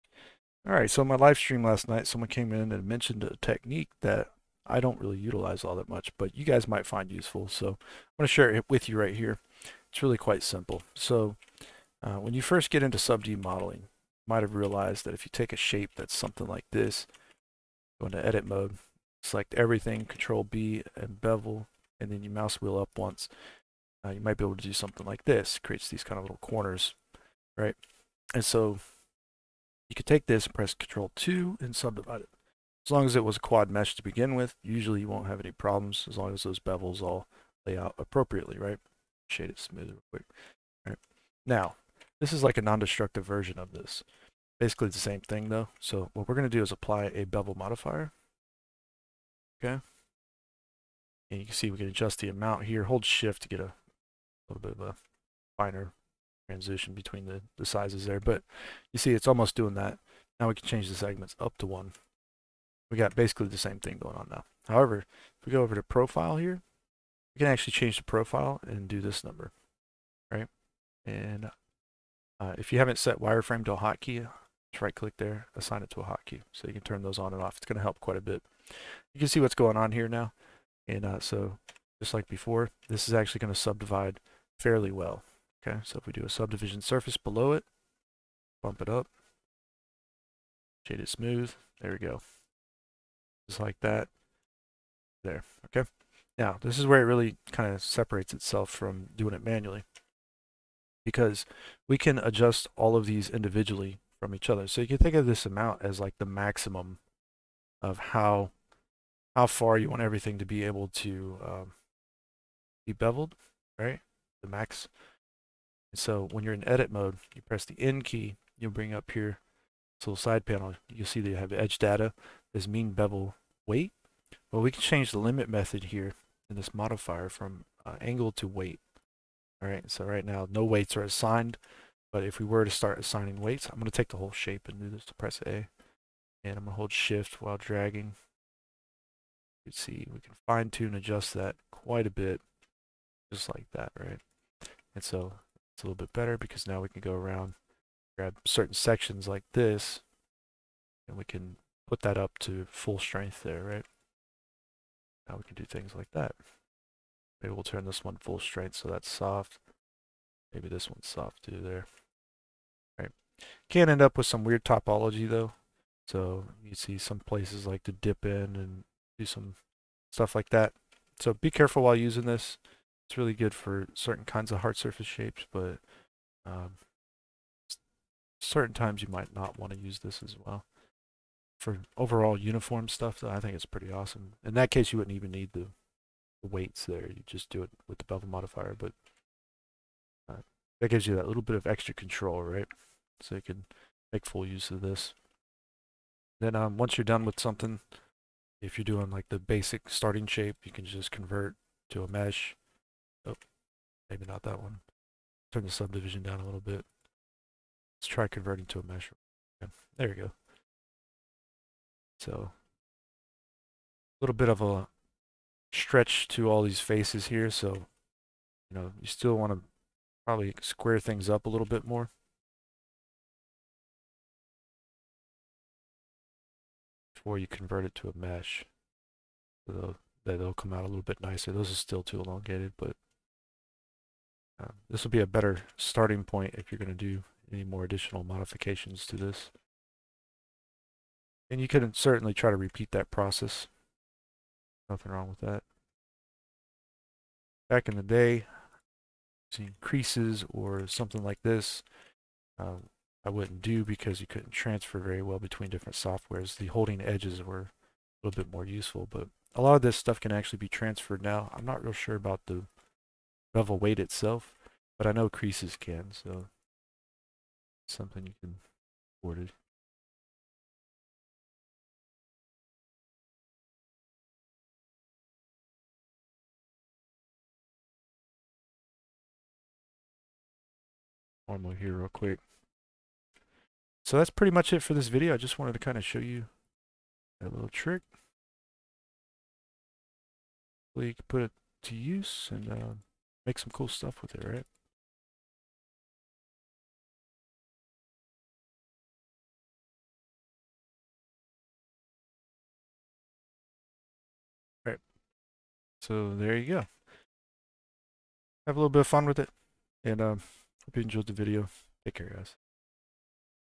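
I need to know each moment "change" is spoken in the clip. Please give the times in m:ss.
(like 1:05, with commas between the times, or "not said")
1:00, 1:07, 2:04.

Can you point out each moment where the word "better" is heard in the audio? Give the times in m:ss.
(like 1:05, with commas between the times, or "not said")
2:26, 3:55.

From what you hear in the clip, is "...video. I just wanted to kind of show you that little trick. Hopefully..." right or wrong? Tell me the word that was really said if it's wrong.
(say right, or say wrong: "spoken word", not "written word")
right.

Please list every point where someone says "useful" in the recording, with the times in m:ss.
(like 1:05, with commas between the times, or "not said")
0:07, 4:18.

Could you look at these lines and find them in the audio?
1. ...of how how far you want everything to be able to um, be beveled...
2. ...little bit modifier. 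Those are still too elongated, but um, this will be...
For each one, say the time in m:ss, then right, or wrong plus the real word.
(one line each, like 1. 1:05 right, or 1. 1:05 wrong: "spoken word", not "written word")
1. 1:47 right
2. 3:50 wrong: "nicer", not "modifier".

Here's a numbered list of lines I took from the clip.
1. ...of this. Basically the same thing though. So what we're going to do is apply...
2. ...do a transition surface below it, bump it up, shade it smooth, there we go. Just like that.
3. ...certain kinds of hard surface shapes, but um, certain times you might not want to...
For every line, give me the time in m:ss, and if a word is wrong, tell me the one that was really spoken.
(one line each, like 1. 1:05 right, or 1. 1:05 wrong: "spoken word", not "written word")
1. 0:43 right
2. 1:26 wrong: "subdivision", not "transition"
3. 2:53 right.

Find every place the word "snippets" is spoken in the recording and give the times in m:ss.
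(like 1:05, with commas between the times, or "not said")
not said.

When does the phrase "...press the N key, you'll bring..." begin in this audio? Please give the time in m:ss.
1:57.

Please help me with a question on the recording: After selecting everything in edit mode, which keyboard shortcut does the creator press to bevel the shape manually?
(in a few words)
Control B.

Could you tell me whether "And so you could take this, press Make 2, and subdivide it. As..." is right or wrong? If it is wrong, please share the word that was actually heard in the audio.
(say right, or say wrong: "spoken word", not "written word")
wrong: "Control", not "Make".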